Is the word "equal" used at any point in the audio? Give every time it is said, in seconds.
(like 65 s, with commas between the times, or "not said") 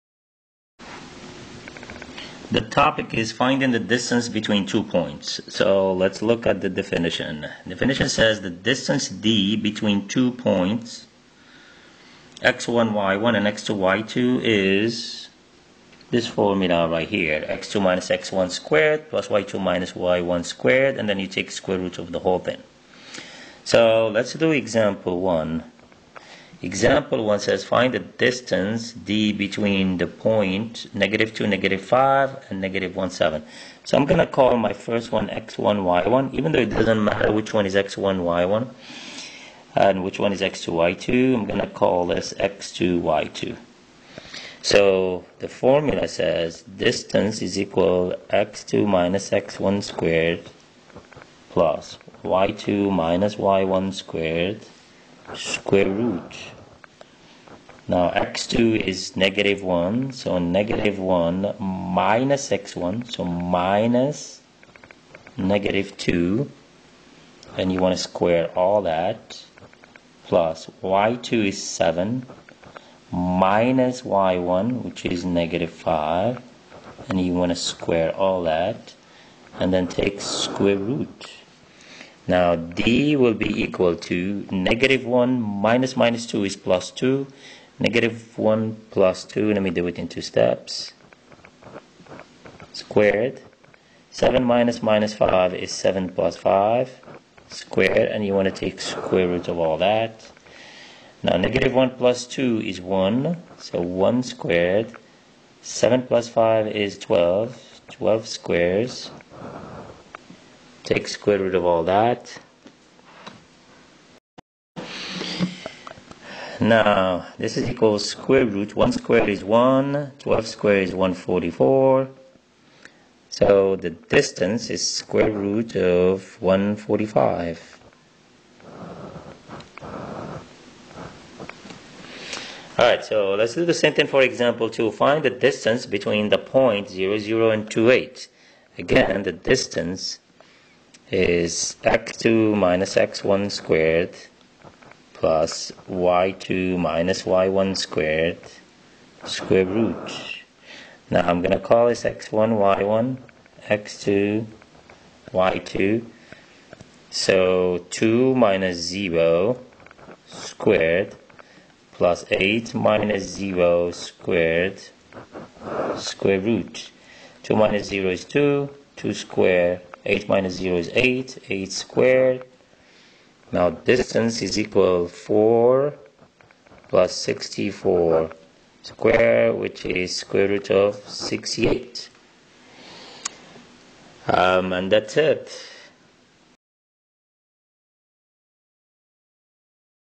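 47 s, 83 s, 174 s.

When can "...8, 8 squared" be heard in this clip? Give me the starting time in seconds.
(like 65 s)
170 s.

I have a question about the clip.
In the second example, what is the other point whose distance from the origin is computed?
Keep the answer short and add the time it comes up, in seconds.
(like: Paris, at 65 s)
2, 8, at 137 s.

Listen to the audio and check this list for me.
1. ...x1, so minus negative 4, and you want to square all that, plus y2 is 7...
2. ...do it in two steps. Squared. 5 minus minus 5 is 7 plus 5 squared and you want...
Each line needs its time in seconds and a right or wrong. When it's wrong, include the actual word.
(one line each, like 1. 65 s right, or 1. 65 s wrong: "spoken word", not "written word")
1. 62 s wrong: "2", not "4"
2. 89 s wrong: "7", not "5".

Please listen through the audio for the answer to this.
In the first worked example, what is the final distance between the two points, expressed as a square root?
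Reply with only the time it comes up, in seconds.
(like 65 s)
124 s.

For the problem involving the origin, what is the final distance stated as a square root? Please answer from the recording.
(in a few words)
square root of 68.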